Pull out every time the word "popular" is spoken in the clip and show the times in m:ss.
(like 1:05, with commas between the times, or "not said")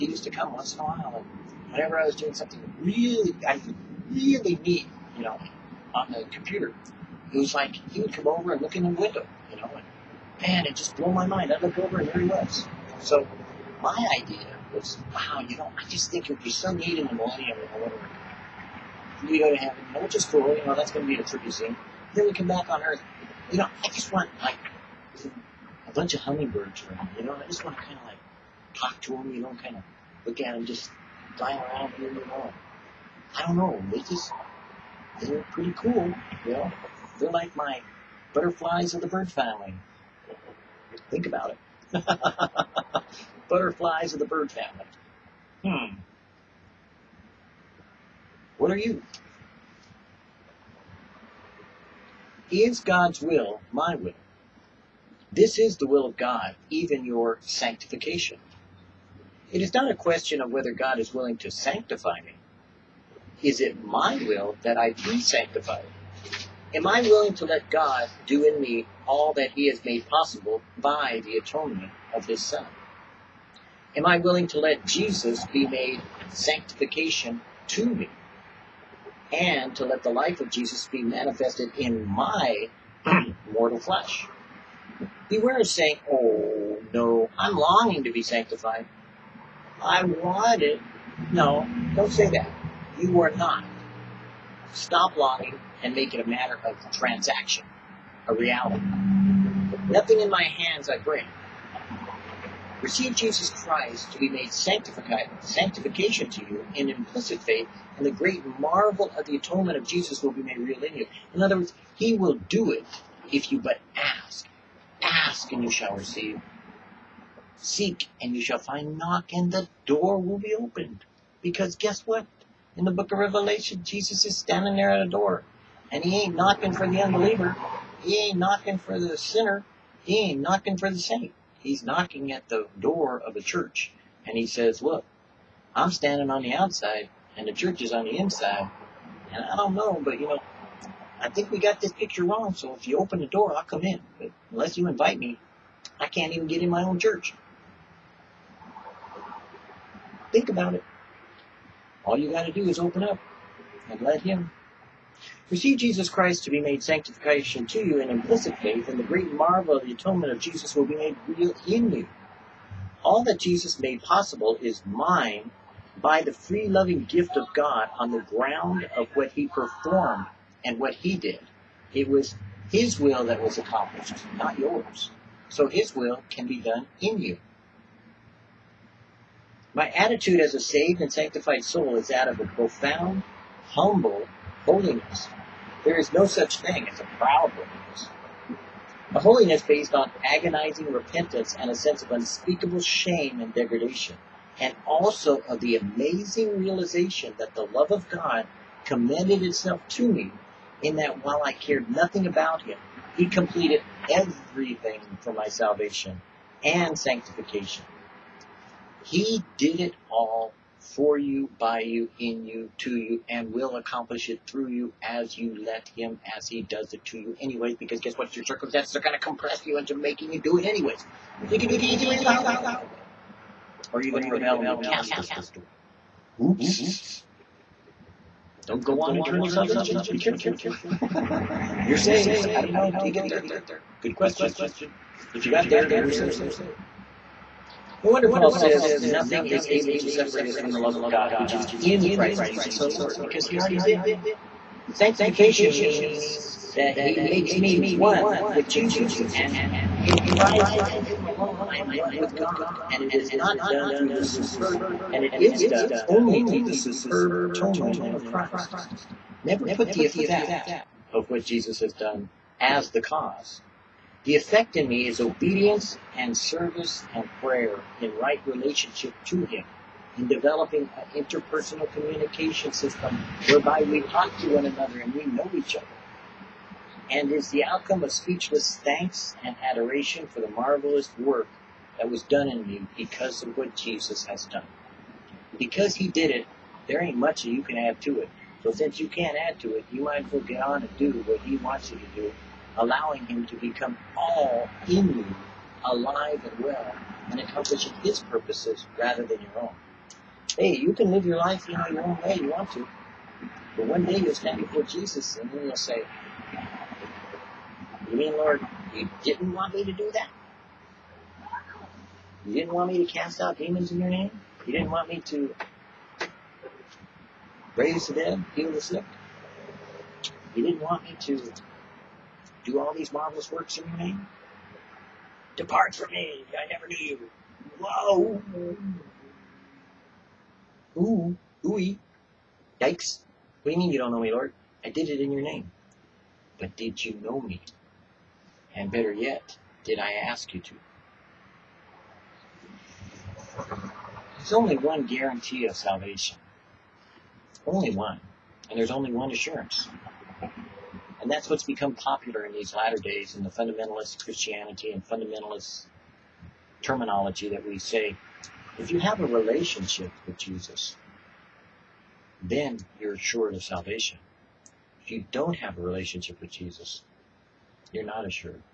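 5:51.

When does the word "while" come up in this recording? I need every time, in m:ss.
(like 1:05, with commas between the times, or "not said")
0:00, 3:21.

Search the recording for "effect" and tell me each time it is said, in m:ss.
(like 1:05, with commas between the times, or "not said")
4:20, 4:24.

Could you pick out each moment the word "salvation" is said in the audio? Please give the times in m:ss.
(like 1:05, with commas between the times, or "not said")
3:25, 3:49, 5:45, 6:03.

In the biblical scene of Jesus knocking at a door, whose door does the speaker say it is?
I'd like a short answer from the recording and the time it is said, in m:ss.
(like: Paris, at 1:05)
a church, at 2:13.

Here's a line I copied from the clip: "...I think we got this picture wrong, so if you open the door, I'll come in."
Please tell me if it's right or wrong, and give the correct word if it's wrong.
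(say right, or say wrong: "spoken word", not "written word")
right.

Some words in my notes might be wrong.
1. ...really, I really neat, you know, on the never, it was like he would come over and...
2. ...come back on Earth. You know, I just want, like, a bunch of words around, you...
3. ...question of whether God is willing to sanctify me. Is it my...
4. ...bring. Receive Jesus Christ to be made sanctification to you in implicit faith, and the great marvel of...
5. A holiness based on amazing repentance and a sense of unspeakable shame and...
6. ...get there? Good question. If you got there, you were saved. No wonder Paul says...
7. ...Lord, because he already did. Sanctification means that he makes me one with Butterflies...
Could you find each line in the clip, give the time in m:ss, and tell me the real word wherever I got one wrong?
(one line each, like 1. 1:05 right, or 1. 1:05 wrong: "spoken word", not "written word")
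1. 0:02 wrong: "computer", not "never"
2. 0:22 wrong: "hummingbirds", not "words"
3. 0:59 right
4. 1:40 right
5. 3:09 wrong: "agonizing", not "amazing"
6. 3:53 right
7. 4:02 wrong: "Jesus", not "Butterflies".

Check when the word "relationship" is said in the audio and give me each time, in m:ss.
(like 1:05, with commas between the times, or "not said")
4:28, 5:59, 6:05.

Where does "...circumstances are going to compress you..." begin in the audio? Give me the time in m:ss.
3:38.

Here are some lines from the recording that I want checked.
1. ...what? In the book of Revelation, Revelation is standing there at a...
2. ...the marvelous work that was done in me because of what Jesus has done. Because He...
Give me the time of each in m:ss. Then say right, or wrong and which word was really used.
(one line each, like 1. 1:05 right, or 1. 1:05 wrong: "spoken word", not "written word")
1. 2:02 wrong: "Jesus", not "Revelation"
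2. 4:40 right.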